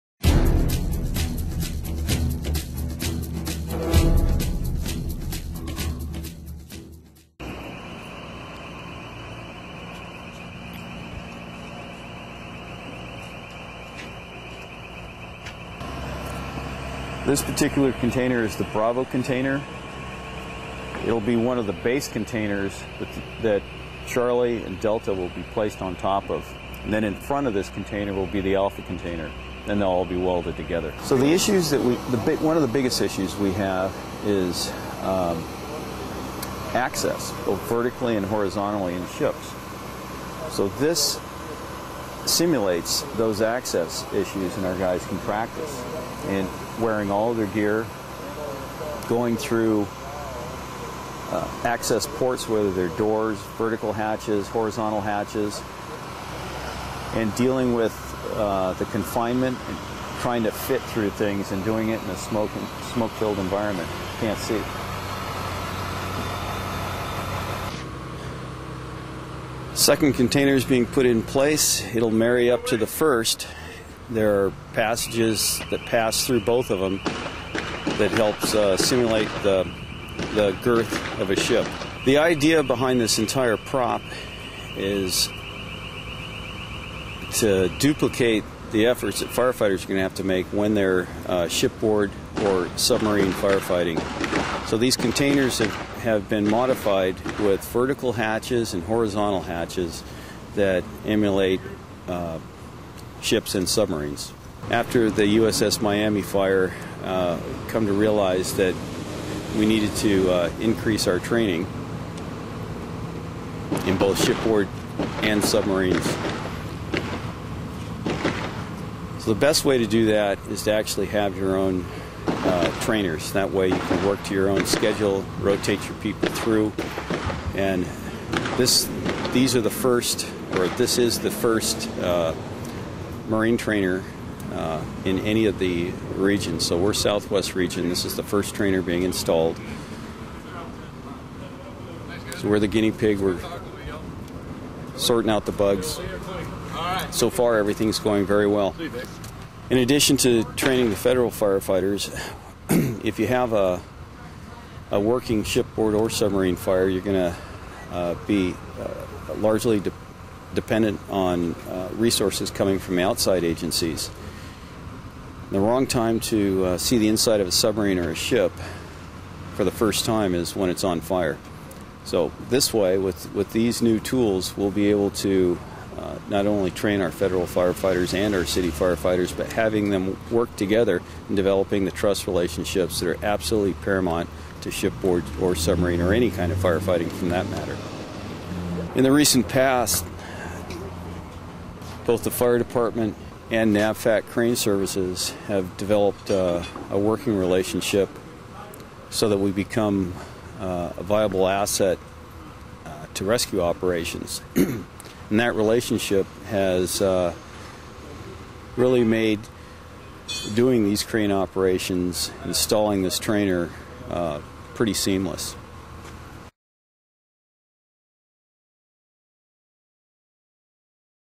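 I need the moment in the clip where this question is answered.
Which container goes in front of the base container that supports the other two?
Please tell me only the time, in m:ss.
0:28.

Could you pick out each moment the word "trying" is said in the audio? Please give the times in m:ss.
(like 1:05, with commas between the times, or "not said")
1:00.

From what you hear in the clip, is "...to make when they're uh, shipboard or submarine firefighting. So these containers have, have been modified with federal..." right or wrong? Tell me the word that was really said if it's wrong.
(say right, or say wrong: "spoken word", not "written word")
wrong: "vertical", not "federal".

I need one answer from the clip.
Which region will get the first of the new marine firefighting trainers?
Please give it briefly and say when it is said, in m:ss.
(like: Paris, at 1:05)
Southwest region, at 2:16.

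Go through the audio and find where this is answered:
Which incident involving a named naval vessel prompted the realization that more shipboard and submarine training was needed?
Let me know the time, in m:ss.
1:45.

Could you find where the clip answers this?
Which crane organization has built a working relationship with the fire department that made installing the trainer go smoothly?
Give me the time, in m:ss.
3:13.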